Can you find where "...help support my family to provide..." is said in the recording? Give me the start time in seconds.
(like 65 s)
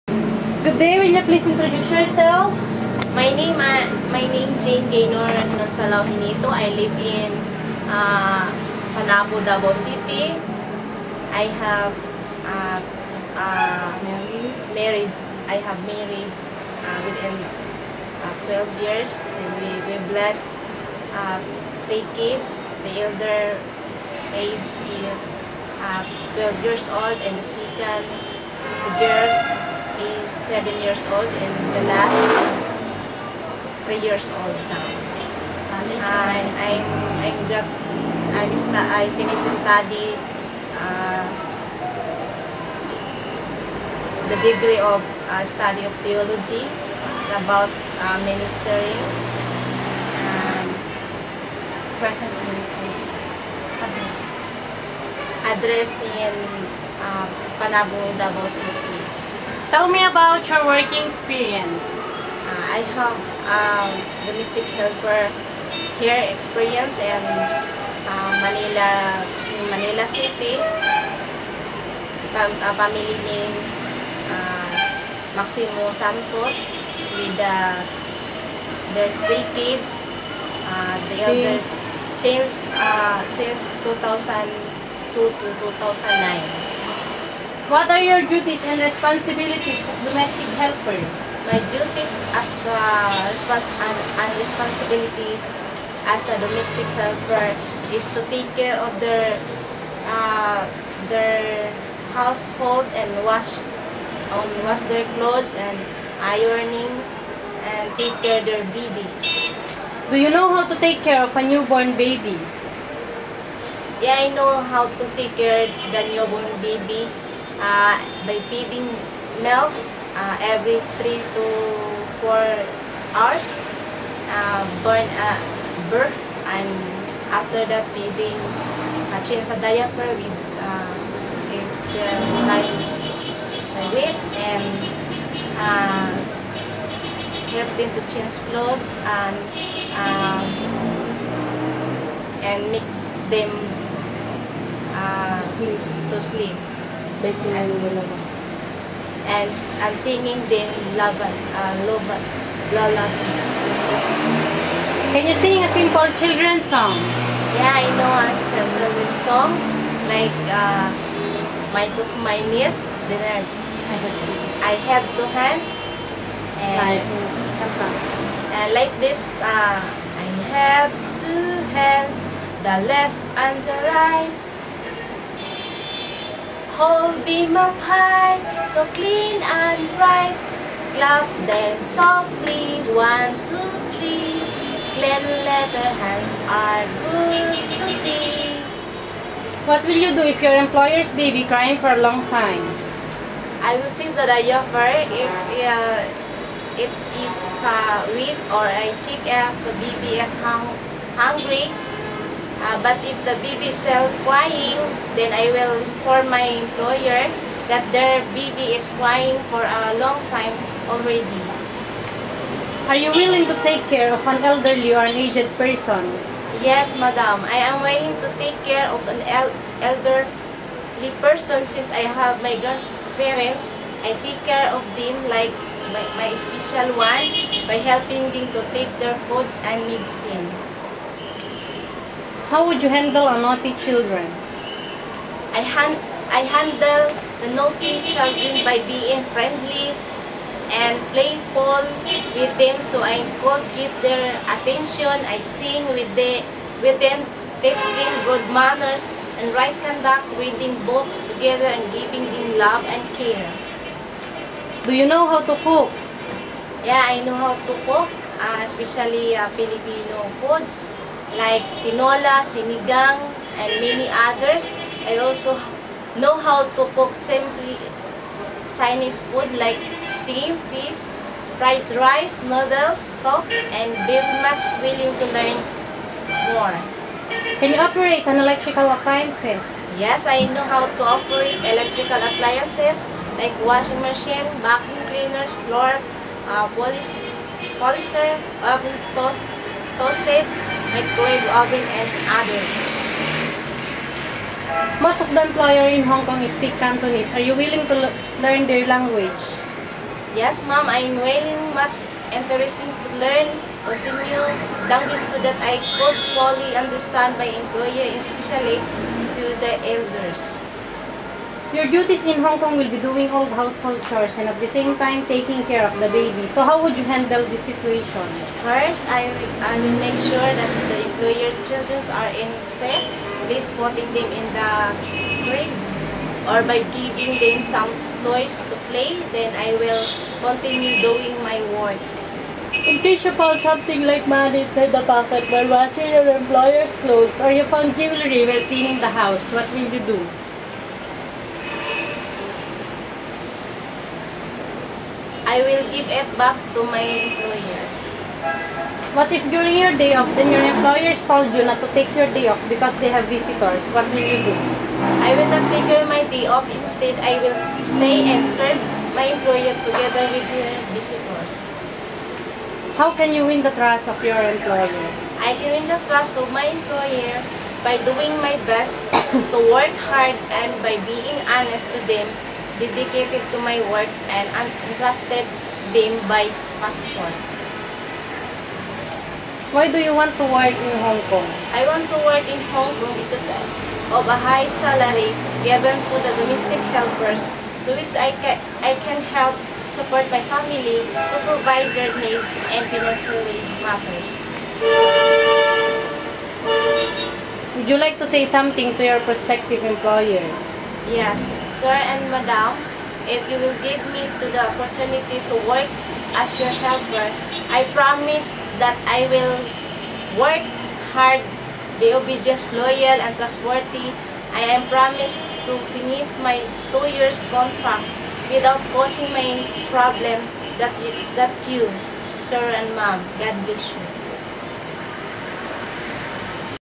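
389 s.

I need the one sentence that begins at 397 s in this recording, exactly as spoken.
Would you like to say something to your prospective employer?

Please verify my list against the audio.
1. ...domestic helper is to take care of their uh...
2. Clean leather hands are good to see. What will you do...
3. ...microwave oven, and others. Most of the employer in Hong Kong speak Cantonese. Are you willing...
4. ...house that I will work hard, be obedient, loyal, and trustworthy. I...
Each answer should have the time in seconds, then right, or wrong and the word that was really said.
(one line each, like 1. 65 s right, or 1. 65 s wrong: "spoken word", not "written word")
1. 96 s right
2. 184 s right
3. 290 s right
4. 407 s wrong: "promise", not "house".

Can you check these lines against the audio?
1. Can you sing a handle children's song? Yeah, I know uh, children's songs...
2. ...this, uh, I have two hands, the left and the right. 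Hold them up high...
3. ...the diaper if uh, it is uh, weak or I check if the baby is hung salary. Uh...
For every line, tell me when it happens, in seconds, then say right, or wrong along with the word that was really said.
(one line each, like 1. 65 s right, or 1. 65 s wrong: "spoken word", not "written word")
1. 155 s wrong: "simple", not "handle"
2. 168 s right
3. 194 s wrong: "hungry", not "salary".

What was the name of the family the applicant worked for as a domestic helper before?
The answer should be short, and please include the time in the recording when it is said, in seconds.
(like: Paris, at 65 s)
Maximo Santos, at 75 s.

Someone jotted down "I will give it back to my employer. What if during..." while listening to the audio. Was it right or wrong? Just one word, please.
right.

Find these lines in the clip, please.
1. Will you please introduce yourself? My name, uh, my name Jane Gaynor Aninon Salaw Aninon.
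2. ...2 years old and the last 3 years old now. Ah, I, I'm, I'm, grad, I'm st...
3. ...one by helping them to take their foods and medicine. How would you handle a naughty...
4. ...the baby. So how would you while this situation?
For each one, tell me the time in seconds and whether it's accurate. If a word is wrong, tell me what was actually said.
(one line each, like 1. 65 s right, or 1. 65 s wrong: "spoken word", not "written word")
1. 1 s wrong: "Hinito", not "Aninon"
2. 30 s wrong: "7", not "2"
3. 226 s right
4. 316 s wrong: "handle", not "while".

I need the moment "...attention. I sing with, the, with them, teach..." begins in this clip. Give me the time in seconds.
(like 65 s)
244 s.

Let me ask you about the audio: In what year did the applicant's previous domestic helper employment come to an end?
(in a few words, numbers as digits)
2009.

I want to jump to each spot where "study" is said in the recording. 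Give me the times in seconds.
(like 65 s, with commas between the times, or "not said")
39 s, 45 s.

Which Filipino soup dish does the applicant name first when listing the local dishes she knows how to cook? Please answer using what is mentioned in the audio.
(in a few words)
Tinola.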